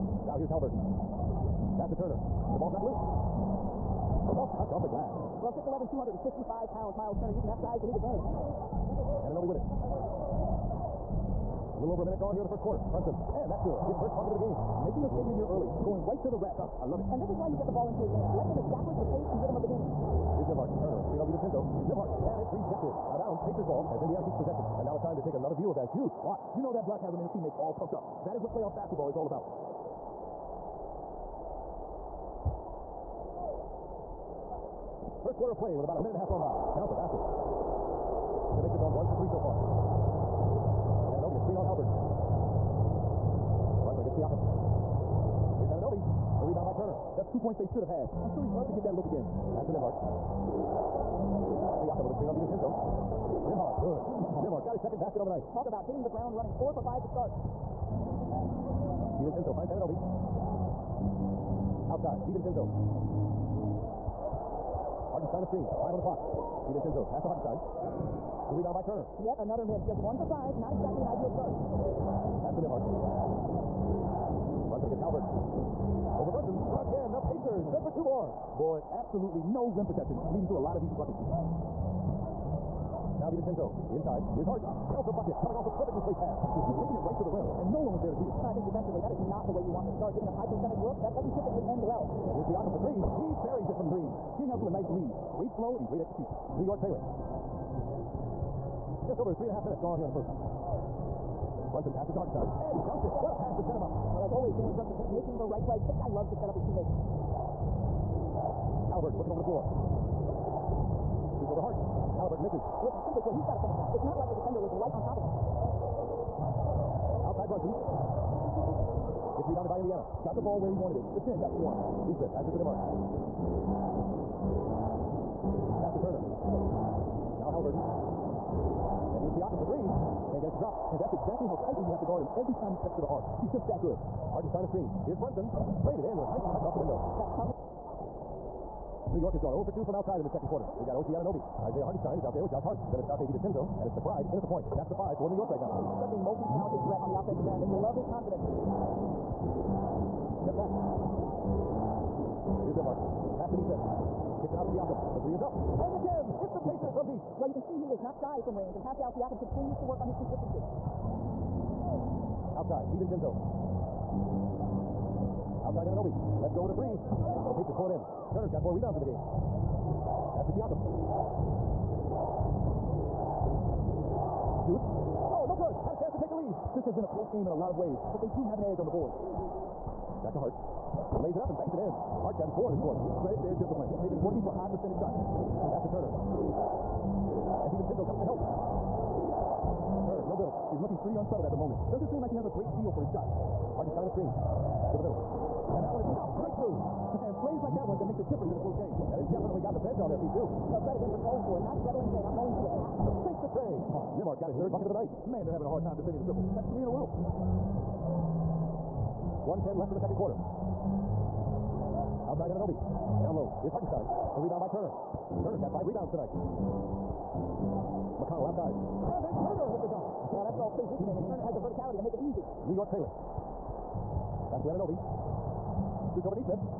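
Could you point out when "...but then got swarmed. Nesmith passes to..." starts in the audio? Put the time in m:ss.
2:01.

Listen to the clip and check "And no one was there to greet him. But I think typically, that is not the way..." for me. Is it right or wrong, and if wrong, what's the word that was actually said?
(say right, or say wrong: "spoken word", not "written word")
wrong: "defensively", not "typically".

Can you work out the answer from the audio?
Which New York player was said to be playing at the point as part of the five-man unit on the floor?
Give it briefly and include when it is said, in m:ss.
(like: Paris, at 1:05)
McBride, at 2:23.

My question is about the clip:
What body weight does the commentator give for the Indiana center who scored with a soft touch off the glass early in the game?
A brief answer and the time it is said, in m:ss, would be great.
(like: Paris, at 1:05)
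255 pounds, at 0:05.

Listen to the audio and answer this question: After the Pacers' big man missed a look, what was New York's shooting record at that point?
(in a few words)
1 for 5.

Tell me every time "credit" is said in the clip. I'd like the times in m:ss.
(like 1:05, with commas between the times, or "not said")
3:03, 3:20.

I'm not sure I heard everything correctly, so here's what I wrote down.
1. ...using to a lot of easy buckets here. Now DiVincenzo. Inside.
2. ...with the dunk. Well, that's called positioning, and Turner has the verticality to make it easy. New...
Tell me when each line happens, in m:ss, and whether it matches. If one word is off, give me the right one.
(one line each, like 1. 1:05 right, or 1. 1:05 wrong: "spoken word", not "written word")
1. 1:20 wrong: "leading", not "using"
2. 3:39 right.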